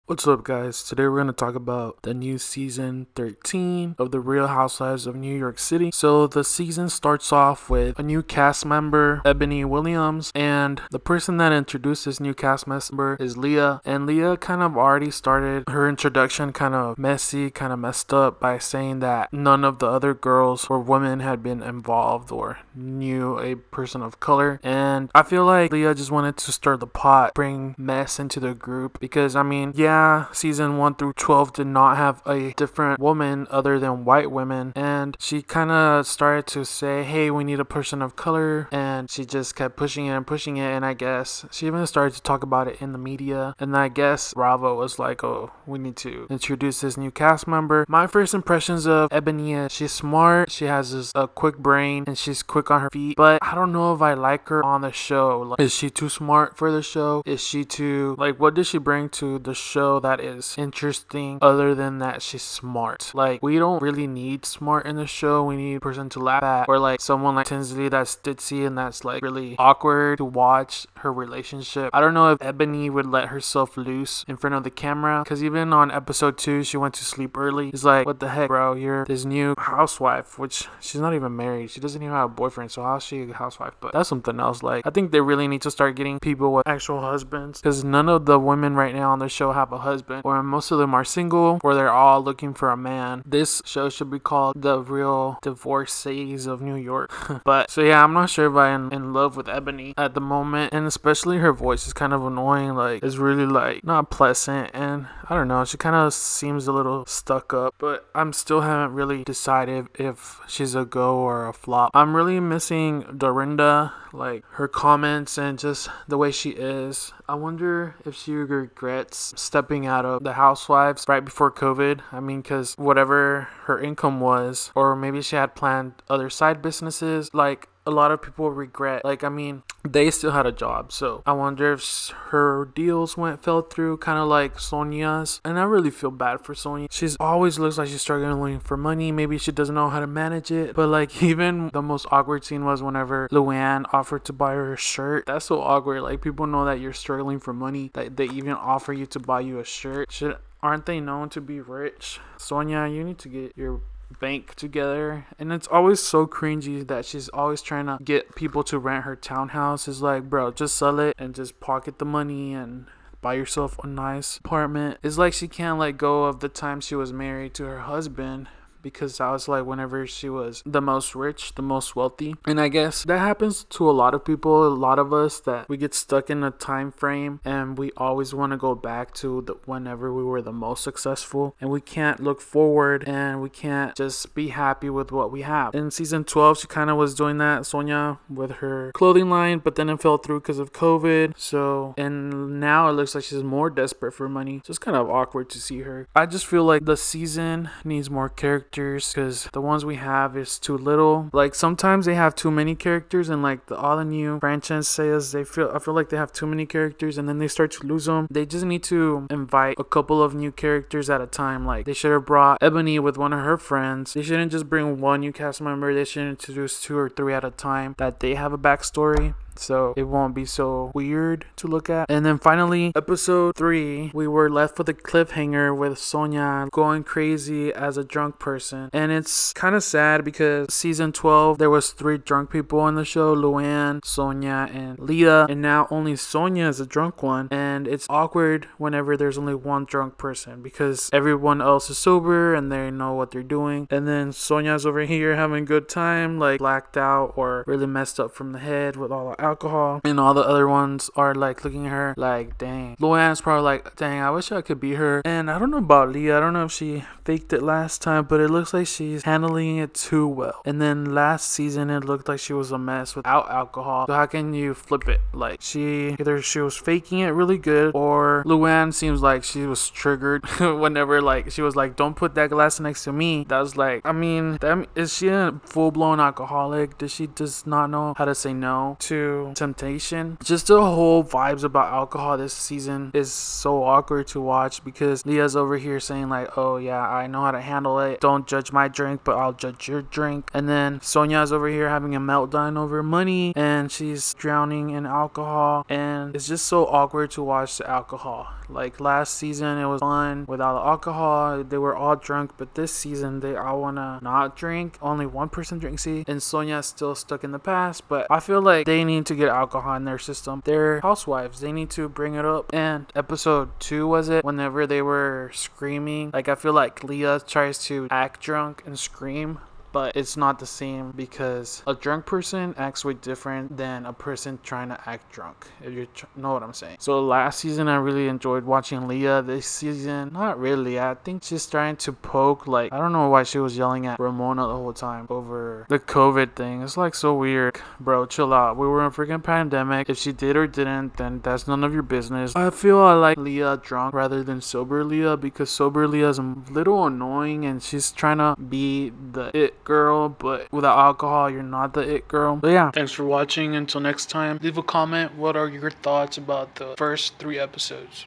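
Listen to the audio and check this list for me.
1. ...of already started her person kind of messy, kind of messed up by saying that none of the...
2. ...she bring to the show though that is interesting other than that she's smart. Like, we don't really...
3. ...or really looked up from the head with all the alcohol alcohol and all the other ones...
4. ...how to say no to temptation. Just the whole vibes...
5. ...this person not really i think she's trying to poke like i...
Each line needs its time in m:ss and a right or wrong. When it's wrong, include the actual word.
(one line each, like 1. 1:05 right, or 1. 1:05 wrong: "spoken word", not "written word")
1. 0:14 wrong: "introduction", not "person"
2. 0:58 right
3. 4:07 wrong: "messed", not "looked"
4. 4:38 right
5. 5:29 wrong: "season", not "person".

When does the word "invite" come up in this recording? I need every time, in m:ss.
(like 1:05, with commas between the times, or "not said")
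3:29.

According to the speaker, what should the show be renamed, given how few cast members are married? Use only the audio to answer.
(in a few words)
The Real Divorcees of New York.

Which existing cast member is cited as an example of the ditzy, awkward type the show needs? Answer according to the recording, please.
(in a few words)
Tinsley.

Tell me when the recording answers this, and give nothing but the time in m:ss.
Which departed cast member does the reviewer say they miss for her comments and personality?
1:51.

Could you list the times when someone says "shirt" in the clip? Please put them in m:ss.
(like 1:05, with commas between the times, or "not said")
2:24, 2:29.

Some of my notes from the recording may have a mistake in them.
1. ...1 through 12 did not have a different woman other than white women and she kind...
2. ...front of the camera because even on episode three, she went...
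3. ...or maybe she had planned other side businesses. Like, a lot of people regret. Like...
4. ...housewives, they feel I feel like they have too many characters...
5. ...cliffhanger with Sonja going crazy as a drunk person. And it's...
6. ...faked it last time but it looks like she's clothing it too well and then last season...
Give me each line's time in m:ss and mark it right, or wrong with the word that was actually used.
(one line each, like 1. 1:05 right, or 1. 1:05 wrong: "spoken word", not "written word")
1. 0:30 right
2. 1:14 wrong: "two", not "three"
3. 2:04 right
4. 3:24 wrong: "franchises", not "housewives"
5. 3:44 right
6. 4:17 wrong: "handling", not "clothing".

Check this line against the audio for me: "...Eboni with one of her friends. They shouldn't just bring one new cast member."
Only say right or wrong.
right.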